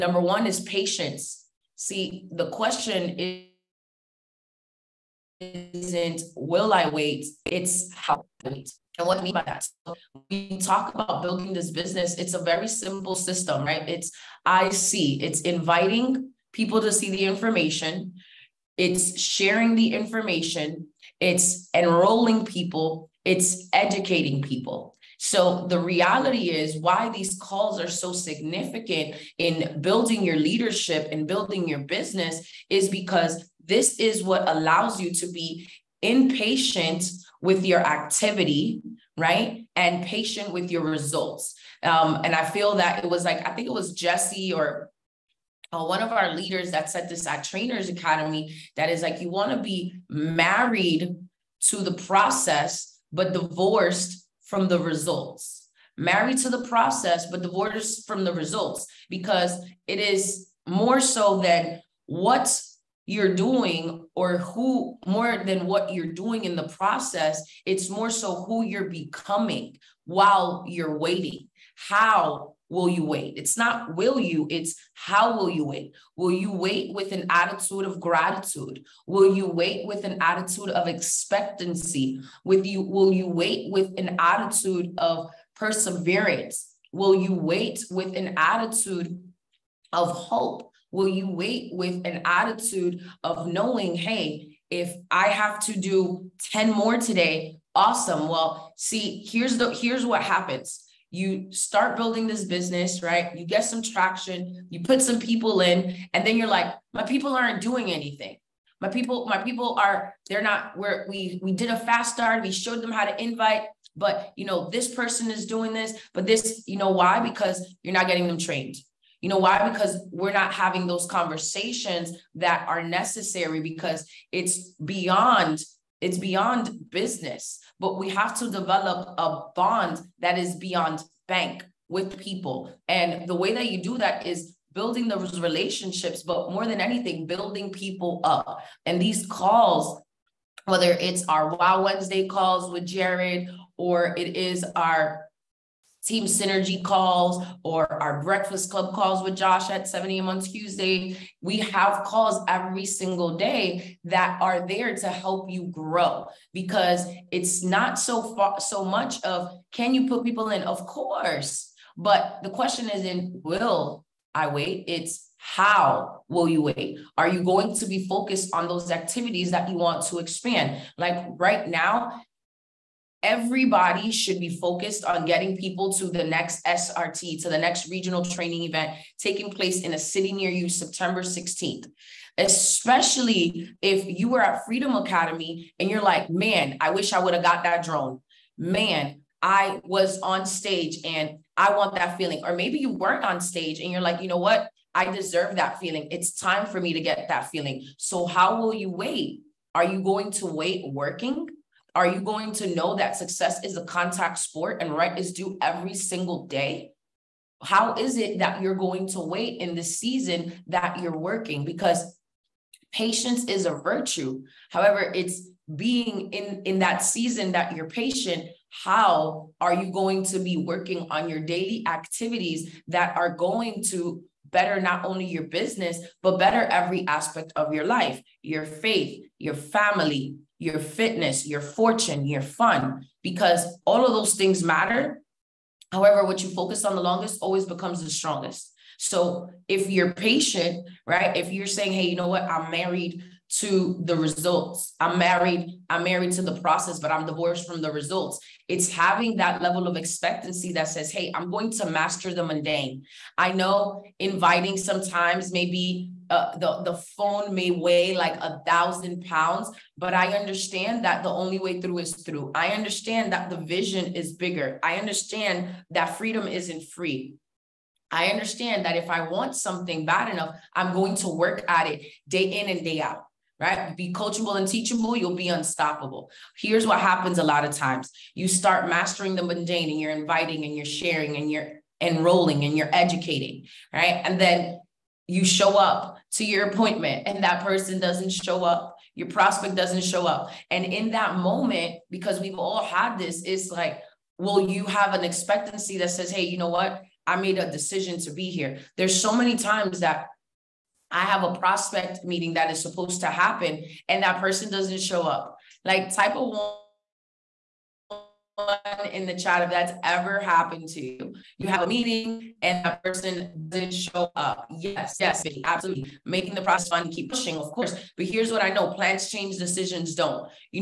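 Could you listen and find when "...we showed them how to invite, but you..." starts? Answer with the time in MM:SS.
01:52.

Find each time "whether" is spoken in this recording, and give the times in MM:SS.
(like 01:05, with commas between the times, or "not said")
02:20.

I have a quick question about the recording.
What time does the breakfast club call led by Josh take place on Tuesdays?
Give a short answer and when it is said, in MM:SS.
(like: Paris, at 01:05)
7 a.m., at 02:29.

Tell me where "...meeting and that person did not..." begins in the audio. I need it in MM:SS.
05:11.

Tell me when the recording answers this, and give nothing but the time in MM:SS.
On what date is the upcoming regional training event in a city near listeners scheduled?
03:00.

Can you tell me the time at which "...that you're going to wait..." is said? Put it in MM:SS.
03:28.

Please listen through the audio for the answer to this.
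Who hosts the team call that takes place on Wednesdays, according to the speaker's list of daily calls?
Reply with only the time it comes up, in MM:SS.
02:22.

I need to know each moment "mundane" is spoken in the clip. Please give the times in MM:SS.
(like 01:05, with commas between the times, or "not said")
04:12, 04:39.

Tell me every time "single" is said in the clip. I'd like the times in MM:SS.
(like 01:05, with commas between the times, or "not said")
02:32, 03:25.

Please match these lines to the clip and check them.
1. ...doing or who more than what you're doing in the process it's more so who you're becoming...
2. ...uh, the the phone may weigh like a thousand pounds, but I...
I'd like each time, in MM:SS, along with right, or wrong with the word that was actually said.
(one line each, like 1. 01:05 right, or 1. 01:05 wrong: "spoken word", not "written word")
1. 01:03 right
2. 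04:16 right.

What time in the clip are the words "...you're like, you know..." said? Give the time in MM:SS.
03:13.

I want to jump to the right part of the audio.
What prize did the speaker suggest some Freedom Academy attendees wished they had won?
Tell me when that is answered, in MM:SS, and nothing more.
03:07.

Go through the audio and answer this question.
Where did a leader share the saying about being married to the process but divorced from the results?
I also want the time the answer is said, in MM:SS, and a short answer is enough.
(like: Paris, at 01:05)
Trainers Academy, at 00:47.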